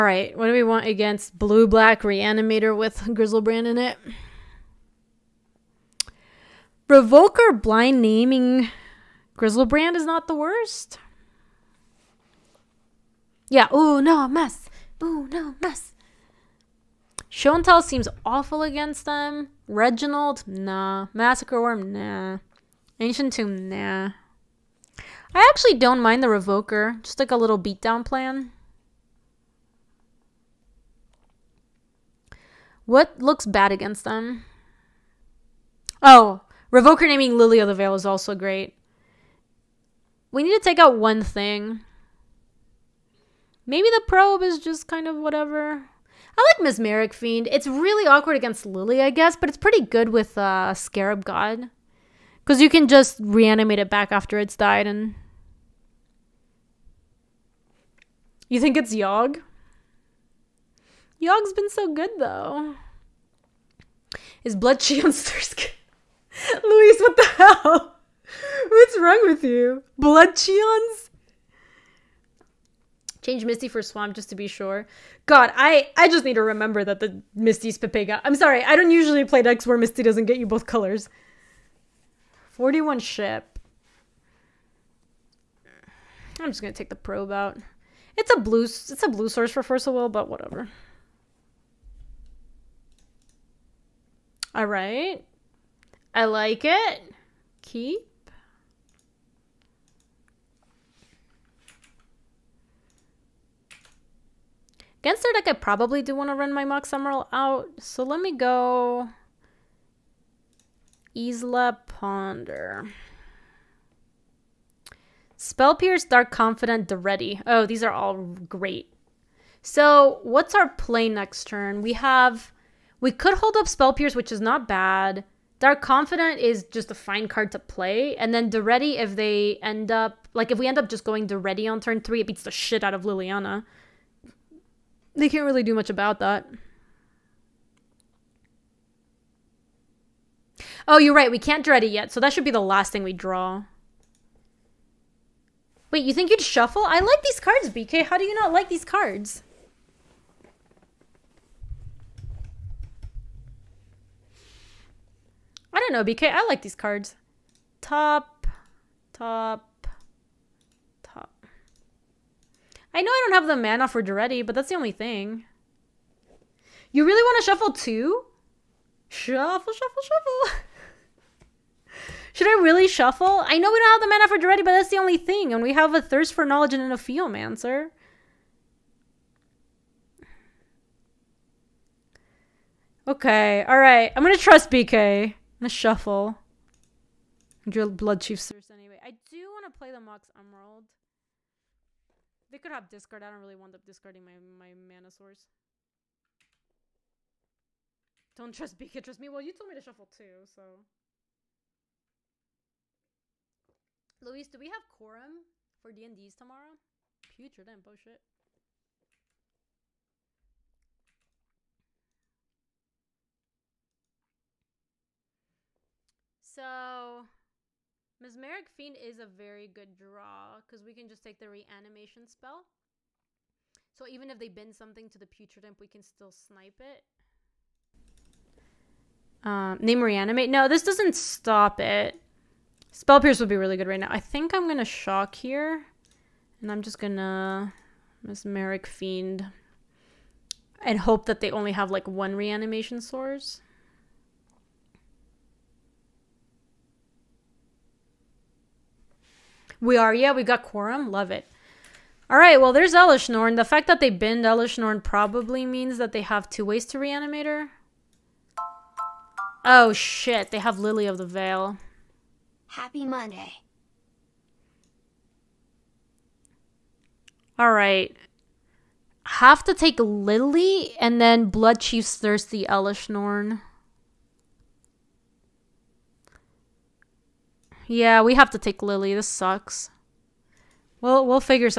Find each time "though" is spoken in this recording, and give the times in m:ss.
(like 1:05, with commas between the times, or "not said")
1:02.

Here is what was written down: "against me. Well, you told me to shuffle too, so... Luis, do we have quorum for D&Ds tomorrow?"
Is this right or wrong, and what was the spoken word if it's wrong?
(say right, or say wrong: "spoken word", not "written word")
wrong: "trust", not "against".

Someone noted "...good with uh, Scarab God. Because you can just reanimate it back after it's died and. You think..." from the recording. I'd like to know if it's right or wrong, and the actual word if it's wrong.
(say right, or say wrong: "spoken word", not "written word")
right.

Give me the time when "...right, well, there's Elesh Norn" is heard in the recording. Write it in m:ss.
4:12.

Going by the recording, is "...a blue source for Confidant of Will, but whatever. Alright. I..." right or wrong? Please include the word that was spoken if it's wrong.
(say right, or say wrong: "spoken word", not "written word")
wrong: "First", not "Confidant".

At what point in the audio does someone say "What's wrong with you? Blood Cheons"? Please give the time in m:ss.
1:08.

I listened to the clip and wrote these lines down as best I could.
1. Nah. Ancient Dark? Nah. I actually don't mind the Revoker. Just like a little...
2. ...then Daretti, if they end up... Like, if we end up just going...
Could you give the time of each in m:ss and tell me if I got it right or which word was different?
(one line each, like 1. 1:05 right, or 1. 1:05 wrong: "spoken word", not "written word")
1. 0:21 wrong: "Tomb", not "Dark"
2. 2:08 right.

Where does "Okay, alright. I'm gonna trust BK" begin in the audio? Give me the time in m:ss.
3:03.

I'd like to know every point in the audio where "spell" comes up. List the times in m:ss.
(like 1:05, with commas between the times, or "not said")
1:55, 2:03, 3:42, 3:52.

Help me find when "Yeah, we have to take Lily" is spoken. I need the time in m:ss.
4:37.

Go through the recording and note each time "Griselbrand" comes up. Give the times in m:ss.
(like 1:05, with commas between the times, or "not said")
0:03, 0:09.